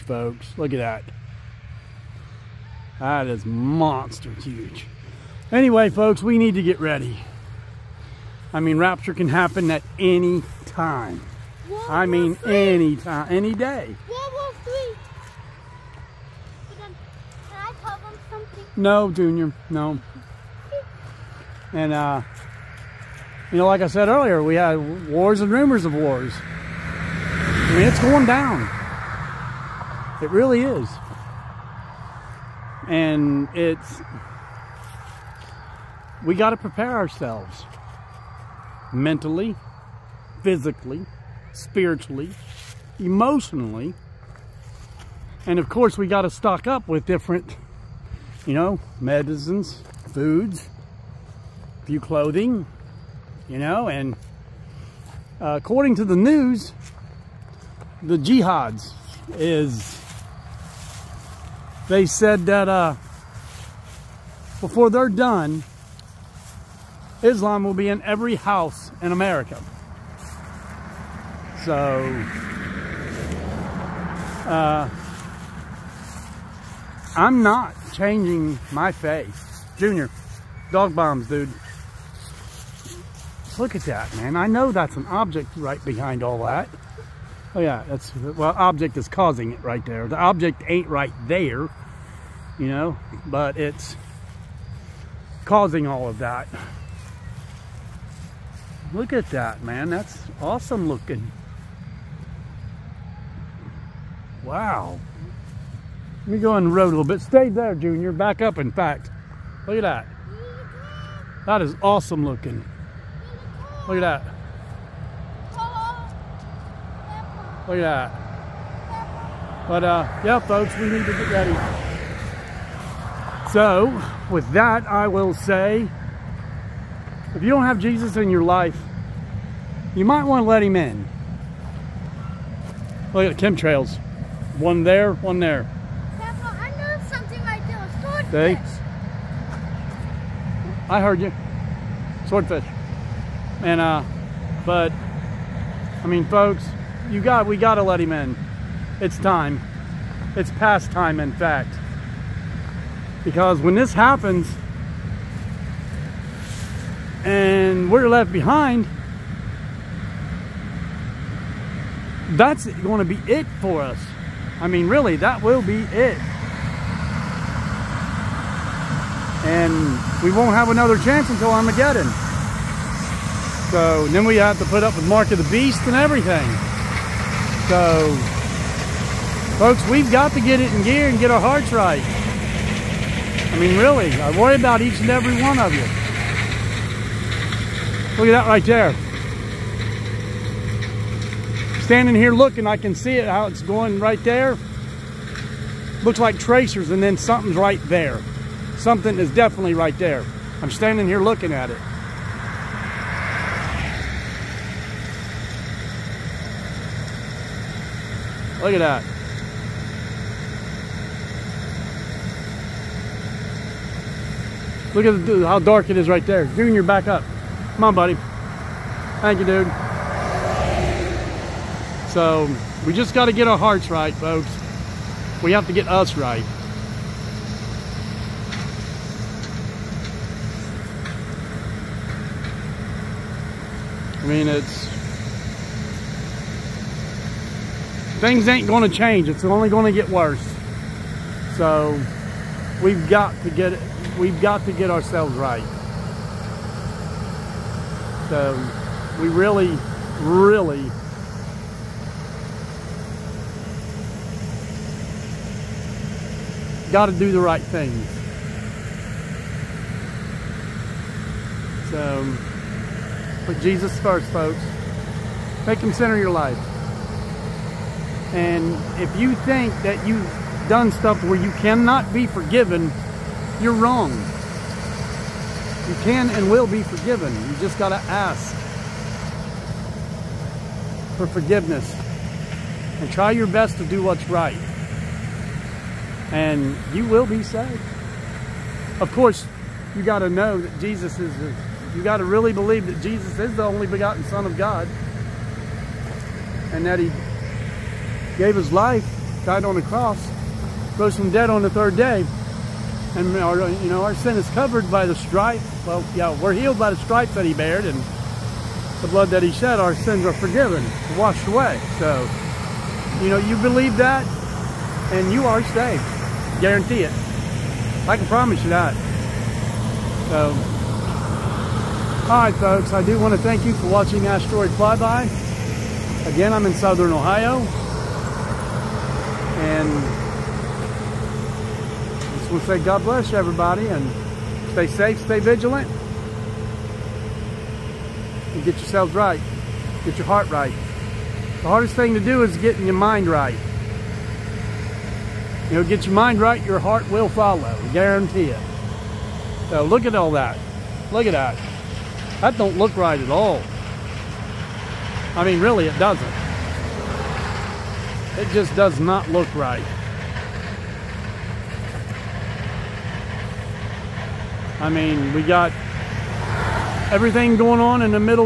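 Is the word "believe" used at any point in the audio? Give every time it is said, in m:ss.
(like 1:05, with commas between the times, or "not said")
4:52, 5:13.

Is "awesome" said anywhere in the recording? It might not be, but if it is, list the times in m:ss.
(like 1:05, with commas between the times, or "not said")
1:40, 1:51.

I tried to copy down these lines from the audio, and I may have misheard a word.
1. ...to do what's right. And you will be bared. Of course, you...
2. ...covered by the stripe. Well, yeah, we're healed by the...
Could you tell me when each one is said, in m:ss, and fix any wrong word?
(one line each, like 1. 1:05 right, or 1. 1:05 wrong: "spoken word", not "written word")
1. 4:43 wrong: "saved", not "bared"
2. 5:04 right.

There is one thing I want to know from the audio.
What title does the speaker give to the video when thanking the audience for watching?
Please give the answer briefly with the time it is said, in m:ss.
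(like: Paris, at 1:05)
Asteroid Flyby, at 5:24.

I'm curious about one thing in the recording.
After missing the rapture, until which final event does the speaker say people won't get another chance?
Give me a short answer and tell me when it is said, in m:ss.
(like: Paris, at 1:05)
Armageddon, at 2:51.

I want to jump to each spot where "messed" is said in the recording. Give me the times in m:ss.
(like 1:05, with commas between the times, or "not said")
not said.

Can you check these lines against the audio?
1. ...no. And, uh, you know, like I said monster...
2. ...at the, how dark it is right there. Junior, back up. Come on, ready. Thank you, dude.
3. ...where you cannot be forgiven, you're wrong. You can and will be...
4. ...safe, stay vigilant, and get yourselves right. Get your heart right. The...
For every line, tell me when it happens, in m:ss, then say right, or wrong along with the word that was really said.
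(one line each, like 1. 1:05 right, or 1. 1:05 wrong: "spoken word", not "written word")
1. 0:19 wrong: "earlier", not "monster"
2. 3:35 wrong: "buddy", not "ready"
3. 4:31 right
4. 5:34 right.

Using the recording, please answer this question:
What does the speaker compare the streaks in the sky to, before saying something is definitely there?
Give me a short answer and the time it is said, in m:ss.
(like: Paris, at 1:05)
Tracers, at 3:16.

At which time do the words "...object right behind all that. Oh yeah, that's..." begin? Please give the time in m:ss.
1:25.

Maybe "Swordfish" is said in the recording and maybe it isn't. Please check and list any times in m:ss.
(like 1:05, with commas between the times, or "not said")
2:18, 2:22.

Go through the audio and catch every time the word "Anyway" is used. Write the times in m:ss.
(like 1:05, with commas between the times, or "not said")
0:05.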